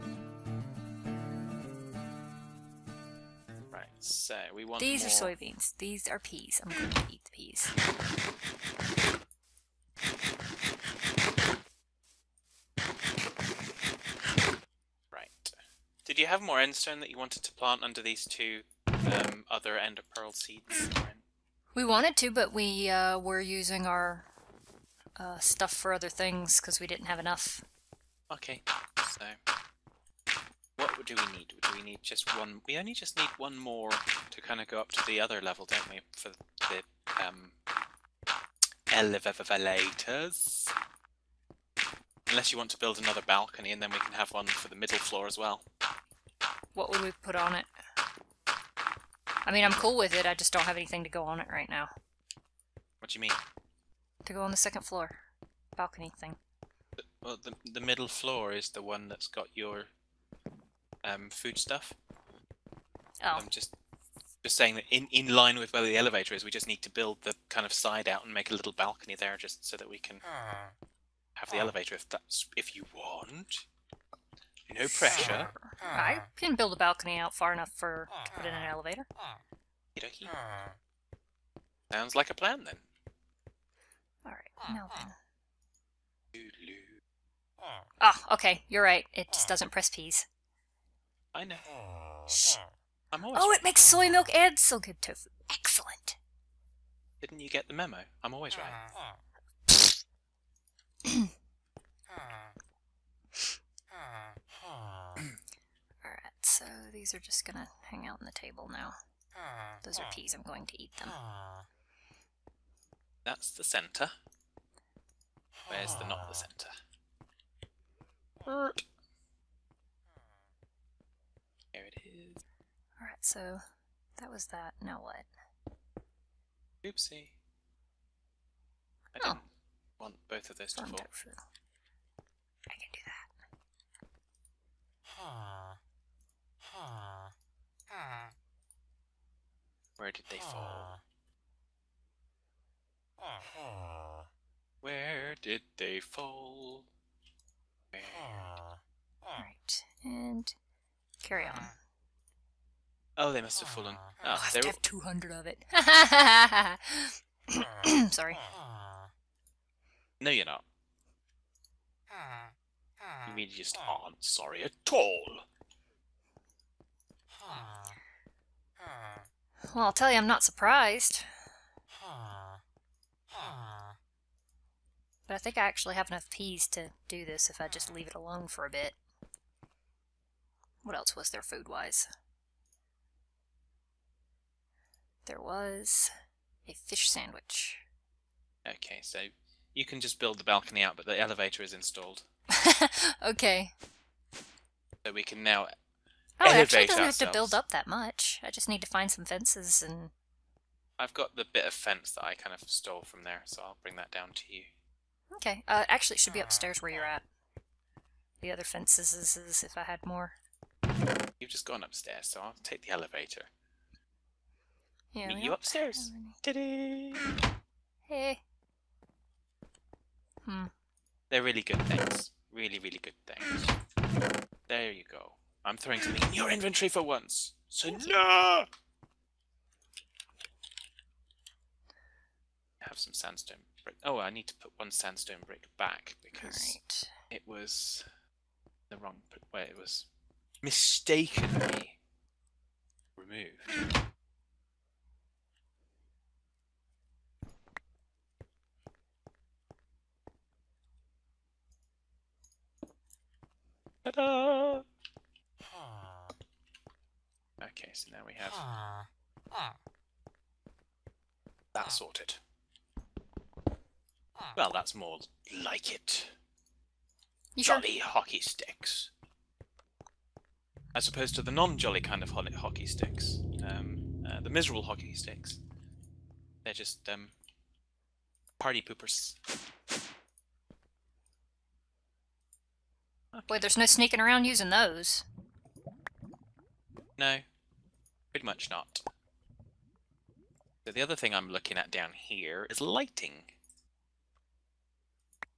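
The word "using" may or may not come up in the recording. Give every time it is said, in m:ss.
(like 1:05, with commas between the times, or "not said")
0:23, 4:44.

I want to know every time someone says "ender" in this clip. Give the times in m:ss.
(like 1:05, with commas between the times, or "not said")
0:19.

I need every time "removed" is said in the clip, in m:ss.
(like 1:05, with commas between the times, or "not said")
4:03.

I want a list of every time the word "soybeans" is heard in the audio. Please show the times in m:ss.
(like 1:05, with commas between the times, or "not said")
0:05.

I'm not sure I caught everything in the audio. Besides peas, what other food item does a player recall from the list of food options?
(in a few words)
fish sandwich.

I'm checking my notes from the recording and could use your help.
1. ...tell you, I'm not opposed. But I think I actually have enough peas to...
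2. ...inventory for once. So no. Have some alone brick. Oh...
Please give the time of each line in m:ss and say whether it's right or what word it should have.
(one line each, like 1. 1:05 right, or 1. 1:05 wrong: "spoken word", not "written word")
1. 2:49 wrong: "surprised", not "opposed"
2. 3:46 wrong: "sandstone", not "alone".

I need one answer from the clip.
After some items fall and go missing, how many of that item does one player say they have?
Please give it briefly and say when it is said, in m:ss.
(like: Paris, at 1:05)
200, at 2:34.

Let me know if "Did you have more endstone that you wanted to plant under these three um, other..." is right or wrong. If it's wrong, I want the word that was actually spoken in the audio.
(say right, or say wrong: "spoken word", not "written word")
wrong: "two", not "three".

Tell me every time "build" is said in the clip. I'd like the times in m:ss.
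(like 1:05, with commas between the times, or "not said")
0:42, 1:06, 1:16, 3:10, 3:17.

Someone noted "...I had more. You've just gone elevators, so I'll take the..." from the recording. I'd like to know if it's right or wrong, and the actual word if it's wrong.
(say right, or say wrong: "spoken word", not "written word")
wrong: "upstairs", not "elevators".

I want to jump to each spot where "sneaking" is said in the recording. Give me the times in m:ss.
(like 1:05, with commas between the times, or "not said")
4:43.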